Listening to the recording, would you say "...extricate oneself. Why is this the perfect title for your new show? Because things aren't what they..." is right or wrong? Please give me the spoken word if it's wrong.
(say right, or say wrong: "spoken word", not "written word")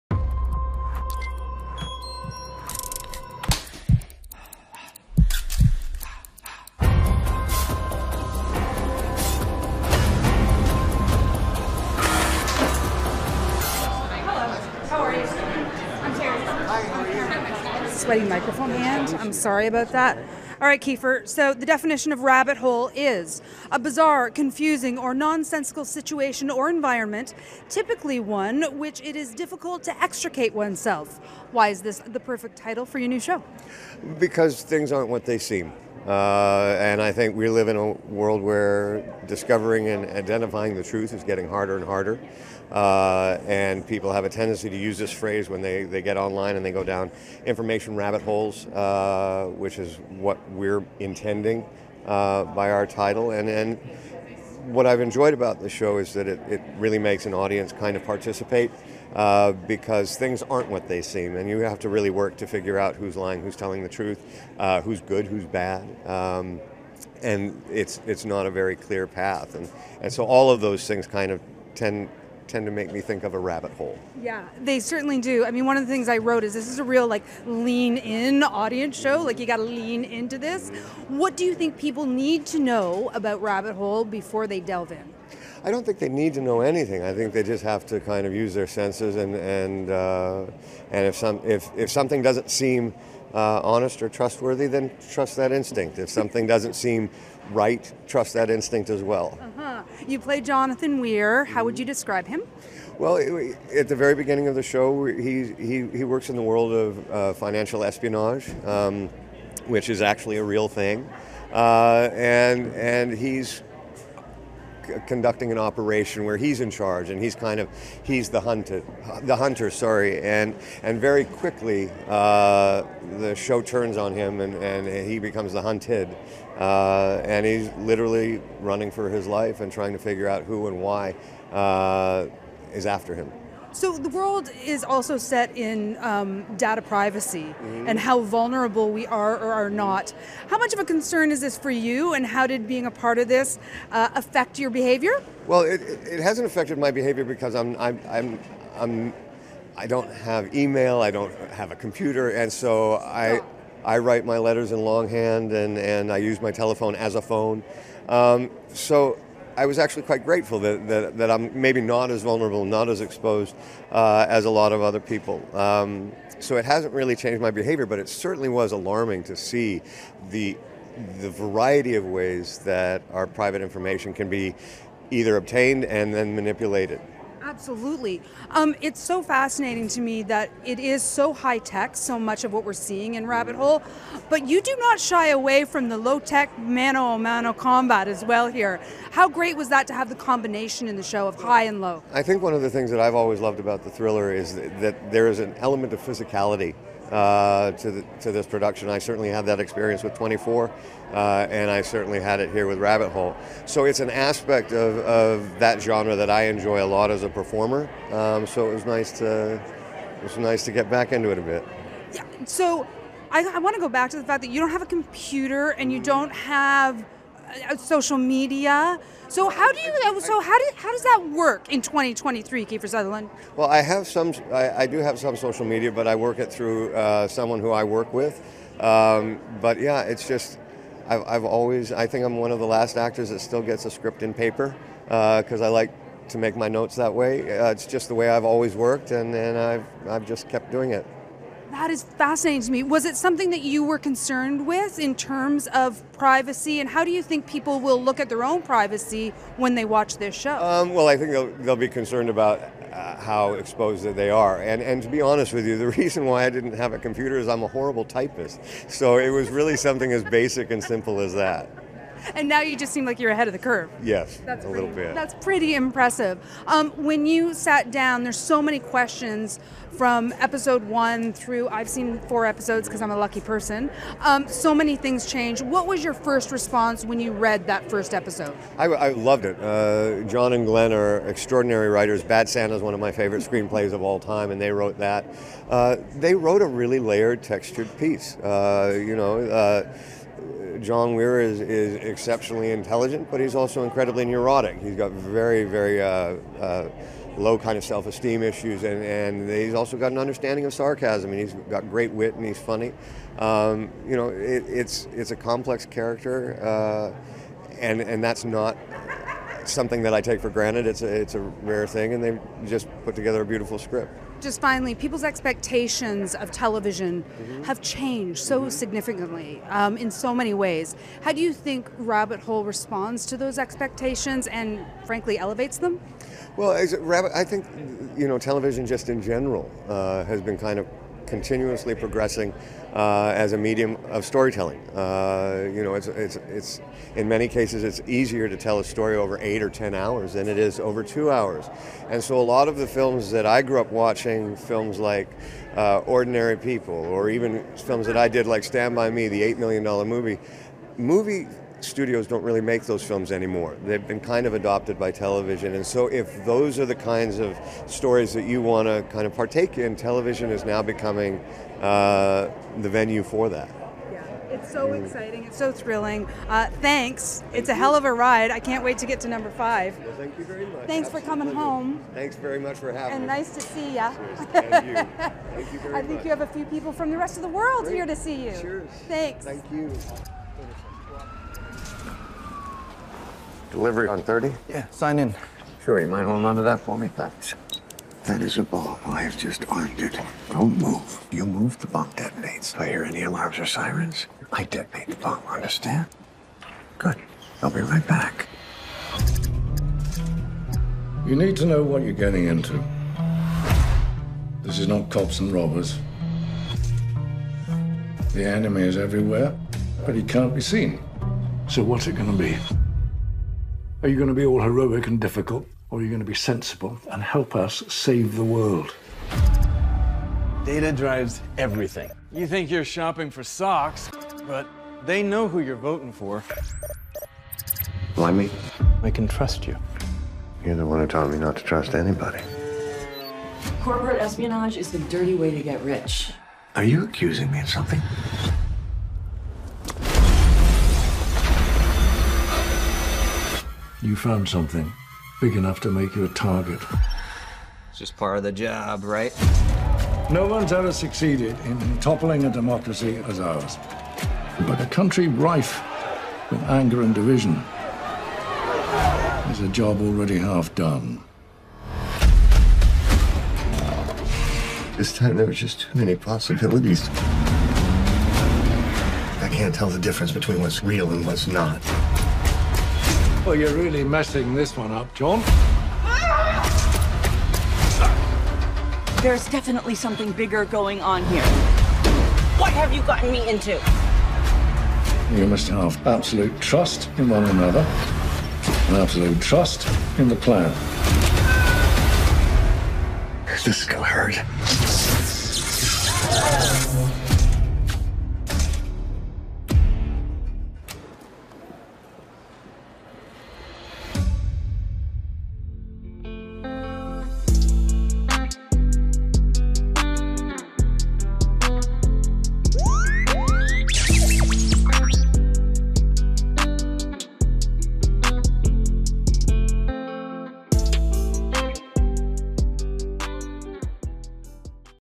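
right.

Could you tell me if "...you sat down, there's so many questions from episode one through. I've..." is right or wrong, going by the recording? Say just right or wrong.
right.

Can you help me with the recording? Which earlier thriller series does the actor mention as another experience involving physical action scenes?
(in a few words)
24.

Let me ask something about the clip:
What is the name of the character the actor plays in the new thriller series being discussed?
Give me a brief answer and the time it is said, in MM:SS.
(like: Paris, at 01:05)
Jonathan Weir, at 01:40.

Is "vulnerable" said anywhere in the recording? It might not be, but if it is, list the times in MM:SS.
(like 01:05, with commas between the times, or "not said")
02:18, 02:42.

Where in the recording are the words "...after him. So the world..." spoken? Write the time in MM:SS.
02:12.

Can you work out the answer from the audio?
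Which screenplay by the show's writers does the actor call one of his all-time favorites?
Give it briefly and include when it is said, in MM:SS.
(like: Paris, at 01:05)
Bad Santa, at 04:42.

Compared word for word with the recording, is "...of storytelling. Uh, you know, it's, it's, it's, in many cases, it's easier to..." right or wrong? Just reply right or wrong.
right.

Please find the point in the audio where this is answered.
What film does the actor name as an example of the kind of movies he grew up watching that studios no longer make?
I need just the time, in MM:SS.
05:45.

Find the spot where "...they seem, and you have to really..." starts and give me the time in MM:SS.
01:00.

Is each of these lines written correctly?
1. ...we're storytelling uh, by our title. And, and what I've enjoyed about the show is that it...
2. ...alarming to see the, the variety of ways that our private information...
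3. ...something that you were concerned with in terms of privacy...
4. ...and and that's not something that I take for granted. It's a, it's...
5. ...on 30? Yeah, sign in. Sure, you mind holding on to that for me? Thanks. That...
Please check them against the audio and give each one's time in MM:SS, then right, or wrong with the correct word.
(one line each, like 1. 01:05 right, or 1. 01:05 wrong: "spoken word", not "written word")
1. 00:50 wrong: "intending", not "storytelling"
2. 02:48 right
3. 04:03 right
4. 05:07 right
5. 06:24 right.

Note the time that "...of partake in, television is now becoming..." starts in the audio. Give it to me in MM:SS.
05:59.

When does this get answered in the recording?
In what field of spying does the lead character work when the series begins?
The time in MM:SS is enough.
01:47.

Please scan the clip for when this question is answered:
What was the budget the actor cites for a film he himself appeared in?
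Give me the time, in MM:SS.
05:49.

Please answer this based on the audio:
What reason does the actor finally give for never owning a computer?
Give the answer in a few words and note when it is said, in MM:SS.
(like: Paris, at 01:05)
horrible typist, at 04:17.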